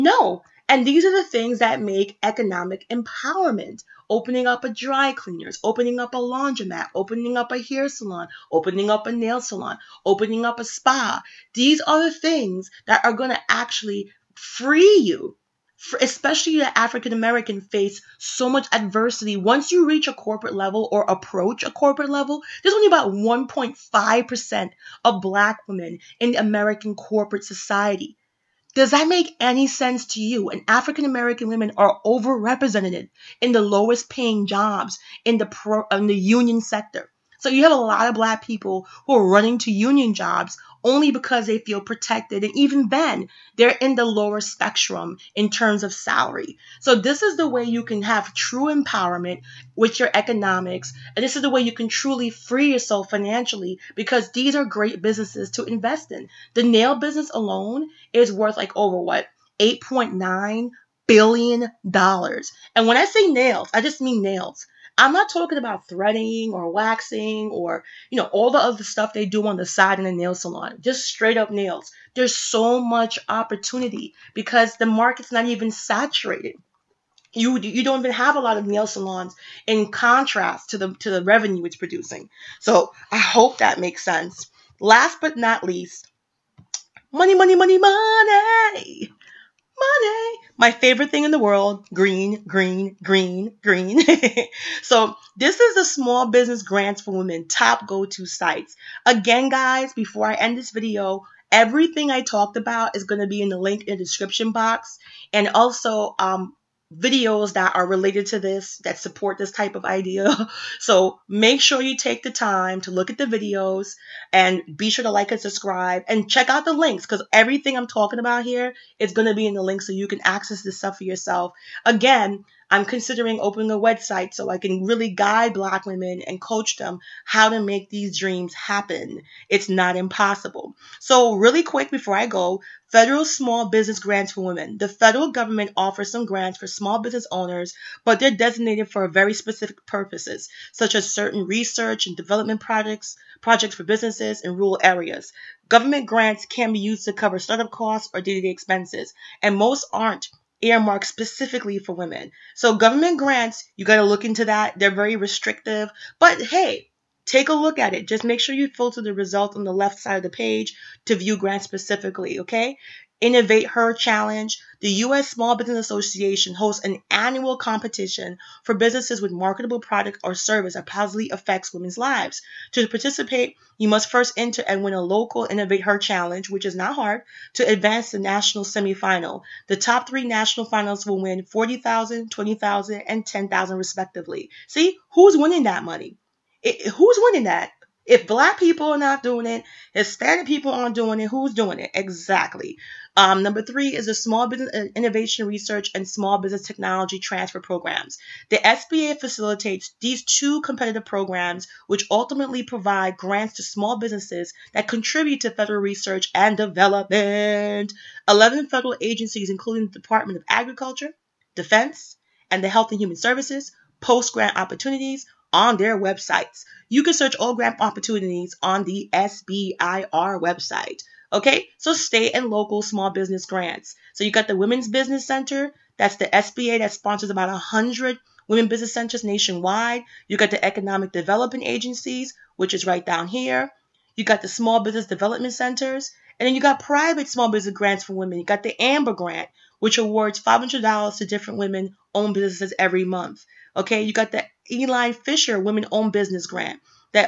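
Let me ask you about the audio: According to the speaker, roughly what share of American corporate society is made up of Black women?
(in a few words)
1.5%.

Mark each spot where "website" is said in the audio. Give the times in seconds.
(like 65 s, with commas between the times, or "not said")
123 s, 215 s, 220 s.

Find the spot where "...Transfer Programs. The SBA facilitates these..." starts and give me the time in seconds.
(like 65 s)
197 s.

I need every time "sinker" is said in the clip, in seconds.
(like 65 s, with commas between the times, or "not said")
not said.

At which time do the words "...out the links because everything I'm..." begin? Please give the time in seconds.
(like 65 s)
116 s.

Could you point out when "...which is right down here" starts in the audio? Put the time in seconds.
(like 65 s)
232 s.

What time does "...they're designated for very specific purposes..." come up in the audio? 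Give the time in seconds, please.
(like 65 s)
138 s.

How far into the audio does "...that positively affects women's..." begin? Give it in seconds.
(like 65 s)
170 s.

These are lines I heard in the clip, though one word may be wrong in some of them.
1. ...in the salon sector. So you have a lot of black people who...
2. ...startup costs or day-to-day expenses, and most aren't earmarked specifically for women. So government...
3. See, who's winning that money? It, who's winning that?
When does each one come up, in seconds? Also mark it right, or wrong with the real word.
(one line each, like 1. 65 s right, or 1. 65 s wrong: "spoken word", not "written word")
1. 35 s wrong: "union", not "salon"
2. 147 s right
3. 184 s right.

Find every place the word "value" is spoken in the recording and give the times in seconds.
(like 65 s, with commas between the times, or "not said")
not said.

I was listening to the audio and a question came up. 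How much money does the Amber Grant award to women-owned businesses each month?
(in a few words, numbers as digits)
$500.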